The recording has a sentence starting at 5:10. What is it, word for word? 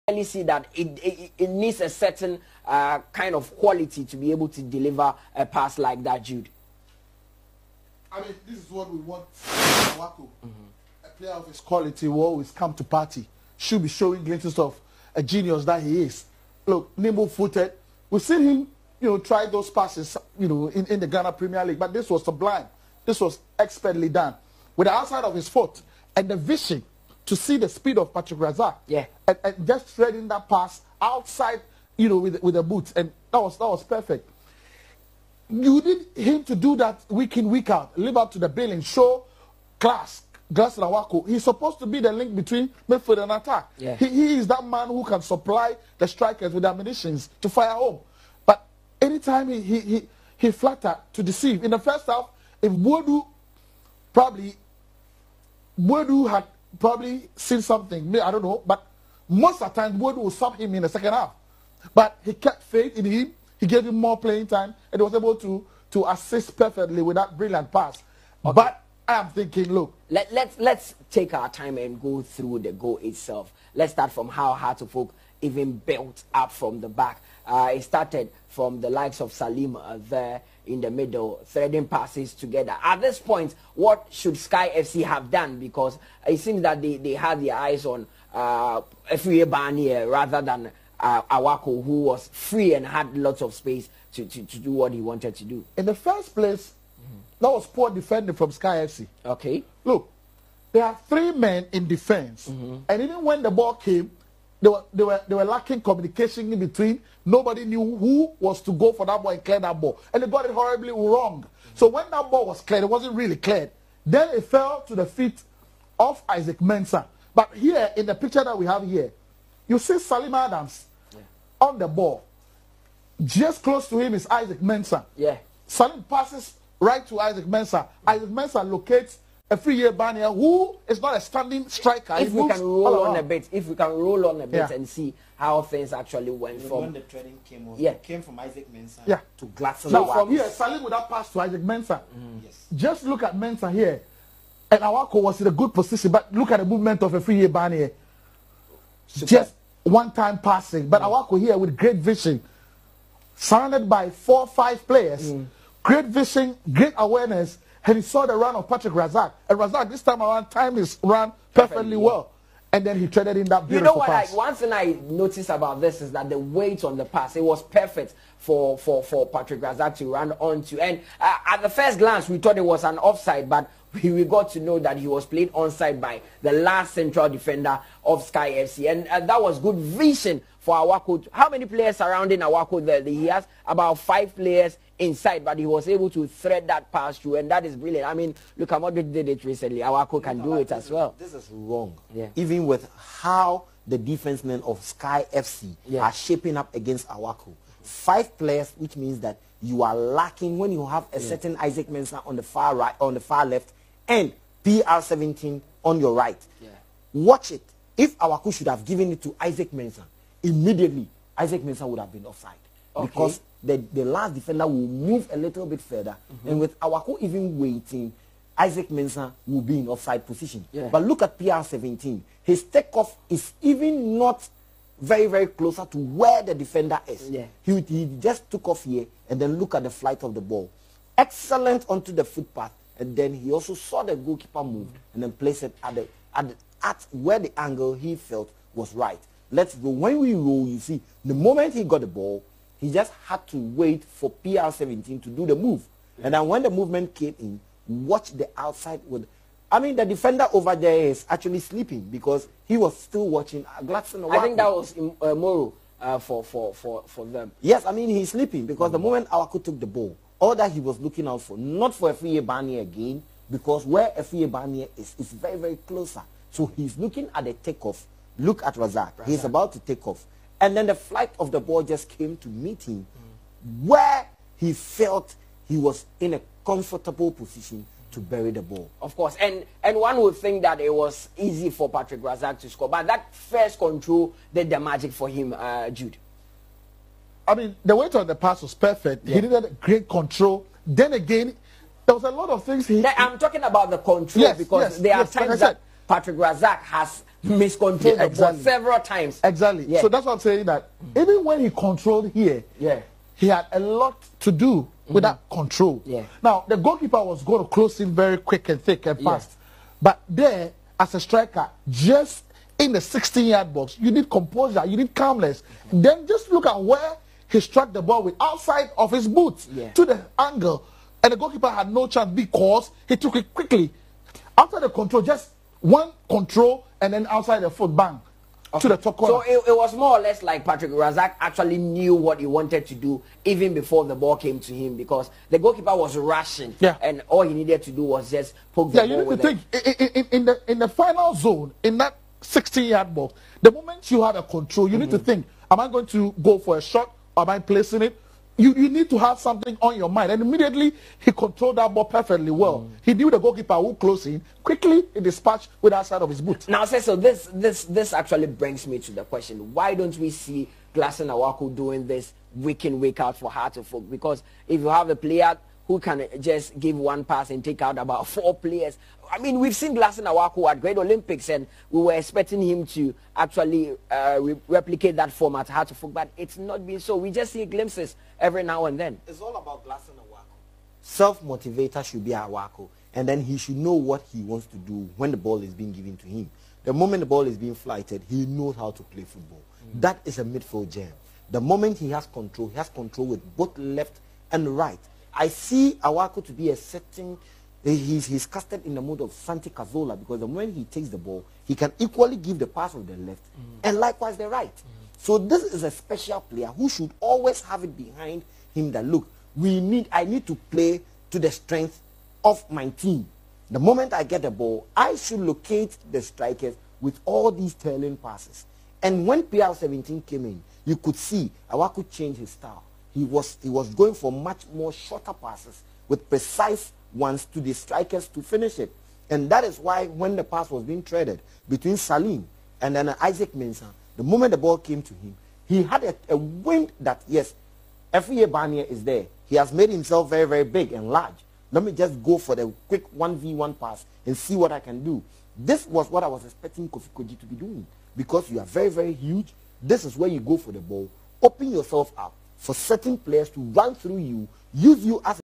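but there as a striker, just in the 16-yard box, you need composure, you need calmness.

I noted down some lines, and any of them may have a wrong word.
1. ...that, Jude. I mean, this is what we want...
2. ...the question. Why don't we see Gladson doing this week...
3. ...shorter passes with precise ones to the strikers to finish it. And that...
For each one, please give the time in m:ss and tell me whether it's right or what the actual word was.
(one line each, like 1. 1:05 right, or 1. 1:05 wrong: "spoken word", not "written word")
1. 0:06 right
2. 5:59 right
3. 7:04 right.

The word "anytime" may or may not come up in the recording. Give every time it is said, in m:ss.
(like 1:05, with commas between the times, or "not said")
0:49.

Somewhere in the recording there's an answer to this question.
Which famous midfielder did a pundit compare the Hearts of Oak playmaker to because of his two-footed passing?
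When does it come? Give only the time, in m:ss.
6:39.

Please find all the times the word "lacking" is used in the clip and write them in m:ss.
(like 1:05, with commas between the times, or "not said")
1:45, 3:19.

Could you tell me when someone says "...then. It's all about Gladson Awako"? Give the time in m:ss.
6:18.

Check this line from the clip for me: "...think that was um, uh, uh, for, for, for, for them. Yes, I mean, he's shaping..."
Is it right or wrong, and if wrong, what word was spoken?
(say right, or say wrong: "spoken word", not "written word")
wrong: "sleeping", not "shaping".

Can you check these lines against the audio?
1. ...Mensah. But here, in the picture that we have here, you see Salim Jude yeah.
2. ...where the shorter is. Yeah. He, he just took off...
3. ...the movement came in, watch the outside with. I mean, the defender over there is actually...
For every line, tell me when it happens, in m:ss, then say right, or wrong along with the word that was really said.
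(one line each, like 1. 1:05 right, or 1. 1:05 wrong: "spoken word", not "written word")
1. 1:56 wrong: "Adams", not "Jude"
2. 3:45 wrong: "defender", not "shorter"
3. 4:06 right.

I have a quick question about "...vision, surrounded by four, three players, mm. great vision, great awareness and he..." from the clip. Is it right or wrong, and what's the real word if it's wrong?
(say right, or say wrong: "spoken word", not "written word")
wrong: "five", not "three".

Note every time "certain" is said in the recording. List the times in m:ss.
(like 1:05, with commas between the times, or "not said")
0:01, 3:21, 6:36, 7:32.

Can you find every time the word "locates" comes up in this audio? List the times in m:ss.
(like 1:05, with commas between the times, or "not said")
2:08, 6:55.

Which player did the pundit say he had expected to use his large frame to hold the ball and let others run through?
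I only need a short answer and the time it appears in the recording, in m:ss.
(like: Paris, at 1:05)
Kofi Kordzi, at 7:26.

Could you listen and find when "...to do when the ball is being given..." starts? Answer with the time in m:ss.
6:24.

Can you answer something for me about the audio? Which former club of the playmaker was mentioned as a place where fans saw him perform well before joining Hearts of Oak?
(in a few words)
Great Olympics.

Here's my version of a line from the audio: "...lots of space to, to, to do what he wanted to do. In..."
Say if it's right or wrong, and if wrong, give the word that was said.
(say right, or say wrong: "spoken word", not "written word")
right.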